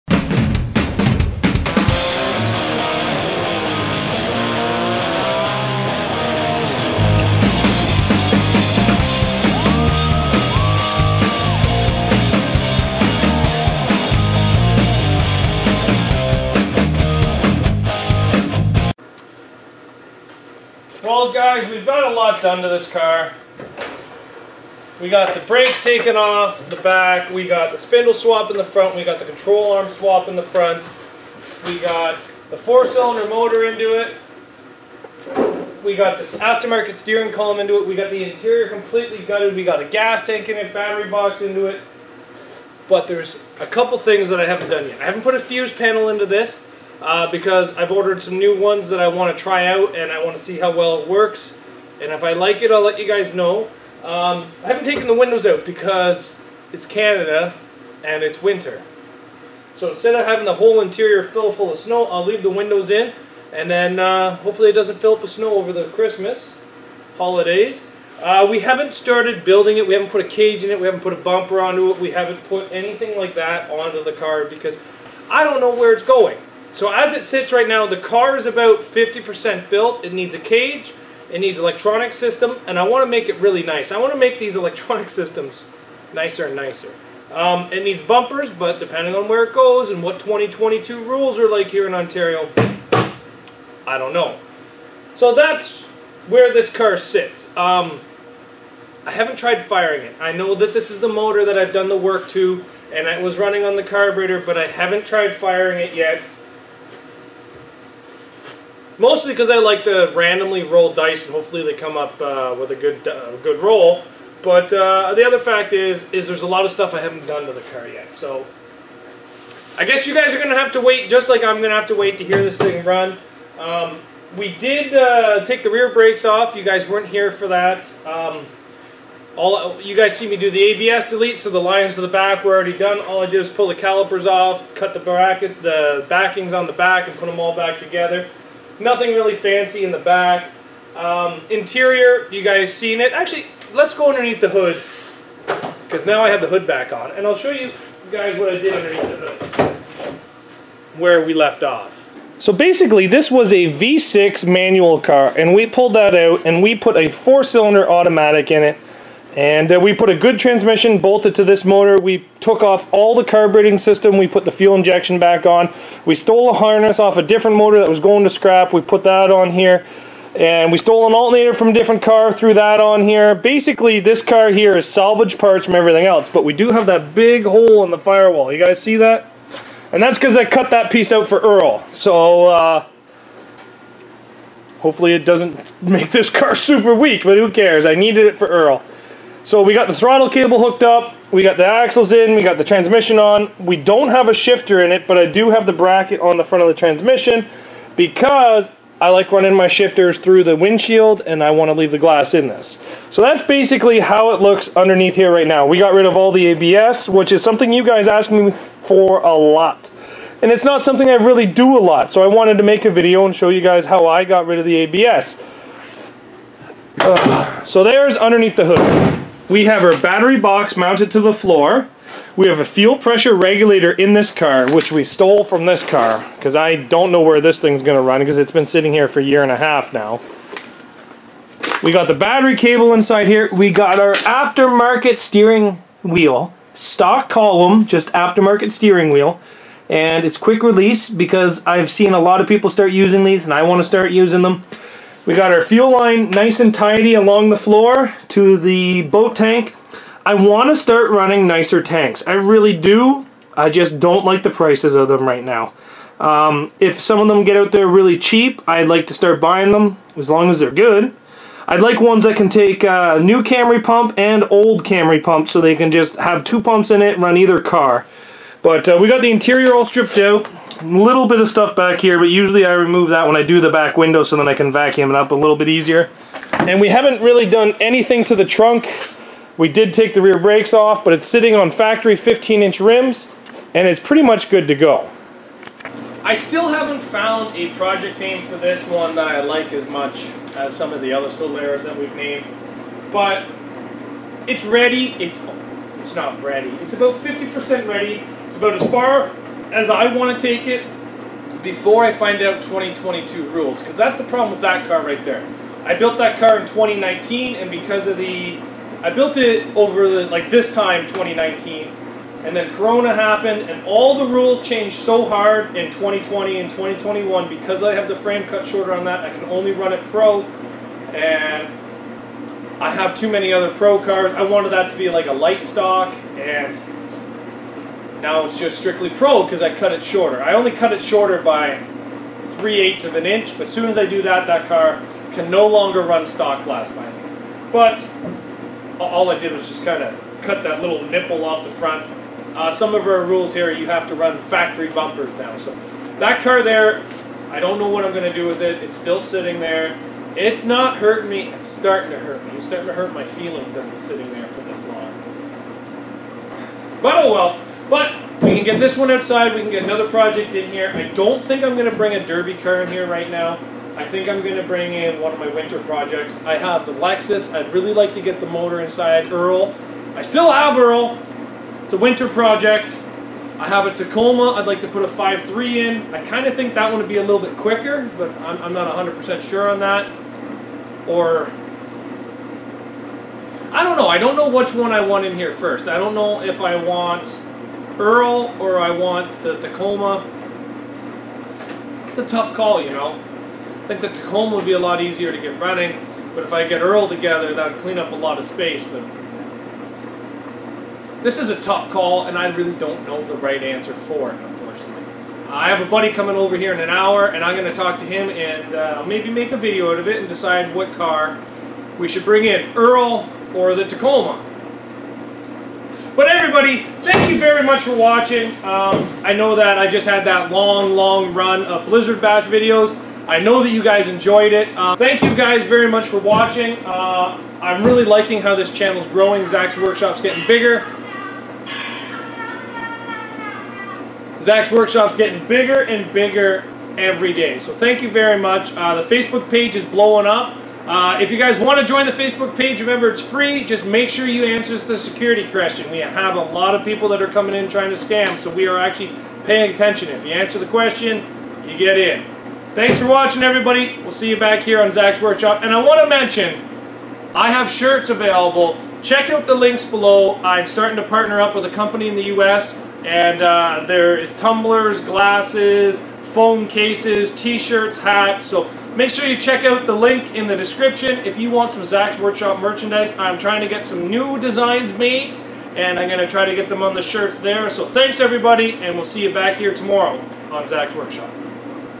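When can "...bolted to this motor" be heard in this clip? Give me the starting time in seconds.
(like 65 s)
160 s.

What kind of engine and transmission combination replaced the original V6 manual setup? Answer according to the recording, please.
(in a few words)
Four-cylinder automatic.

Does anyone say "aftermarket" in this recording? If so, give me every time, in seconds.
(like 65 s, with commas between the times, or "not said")
36 s, 234 s, 238 s.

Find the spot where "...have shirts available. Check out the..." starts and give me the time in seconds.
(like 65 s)
457 s.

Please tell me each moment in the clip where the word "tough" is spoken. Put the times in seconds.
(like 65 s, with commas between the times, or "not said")
392 s, 401 s.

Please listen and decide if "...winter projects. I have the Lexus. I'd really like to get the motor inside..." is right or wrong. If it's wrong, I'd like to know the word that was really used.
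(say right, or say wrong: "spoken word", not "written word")
right.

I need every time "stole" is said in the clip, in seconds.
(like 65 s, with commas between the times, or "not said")
166 s, 170 s, 225 s.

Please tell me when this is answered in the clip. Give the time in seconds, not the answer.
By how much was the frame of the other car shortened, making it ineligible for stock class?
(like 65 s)
332 s.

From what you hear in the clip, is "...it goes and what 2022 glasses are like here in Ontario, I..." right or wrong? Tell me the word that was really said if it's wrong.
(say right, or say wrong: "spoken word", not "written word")
wrong: "rules", not "glasses".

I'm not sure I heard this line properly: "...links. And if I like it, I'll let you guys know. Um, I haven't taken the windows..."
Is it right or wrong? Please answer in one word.
wrong.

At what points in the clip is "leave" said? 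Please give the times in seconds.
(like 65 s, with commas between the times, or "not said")
62 s, 201 s.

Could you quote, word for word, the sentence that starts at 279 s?
We did take the rear brakes off, but it's sitting on factory 15-inch rims, and it's pretty much good to go.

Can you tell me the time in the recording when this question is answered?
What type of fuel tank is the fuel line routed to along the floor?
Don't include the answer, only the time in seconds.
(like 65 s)
249 s.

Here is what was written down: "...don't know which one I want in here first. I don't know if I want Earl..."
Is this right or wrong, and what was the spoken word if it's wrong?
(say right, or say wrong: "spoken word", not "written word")
right.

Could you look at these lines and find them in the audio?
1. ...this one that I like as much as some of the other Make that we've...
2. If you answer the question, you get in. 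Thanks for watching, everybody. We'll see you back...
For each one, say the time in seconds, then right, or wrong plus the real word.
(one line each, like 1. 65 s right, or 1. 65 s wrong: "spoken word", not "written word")
1. 288 s wrong: "Solaras", not "Make"
2. 450 s right.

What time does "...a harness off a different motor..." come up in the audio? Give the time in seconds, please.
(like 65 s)
166 s.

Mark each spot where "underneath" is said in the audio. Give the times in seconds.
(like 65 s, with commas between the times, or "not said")
144 s, 148 s, 204 s, 218 s.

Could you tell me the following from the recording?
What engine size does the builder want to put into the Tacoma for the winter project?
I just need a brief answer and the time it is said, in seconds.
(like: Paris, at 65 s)
5.3, at 375 s.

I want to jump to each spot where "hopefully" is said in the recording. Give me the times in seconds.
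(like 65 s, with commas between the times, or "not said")
64 s, 111 s, 184 s.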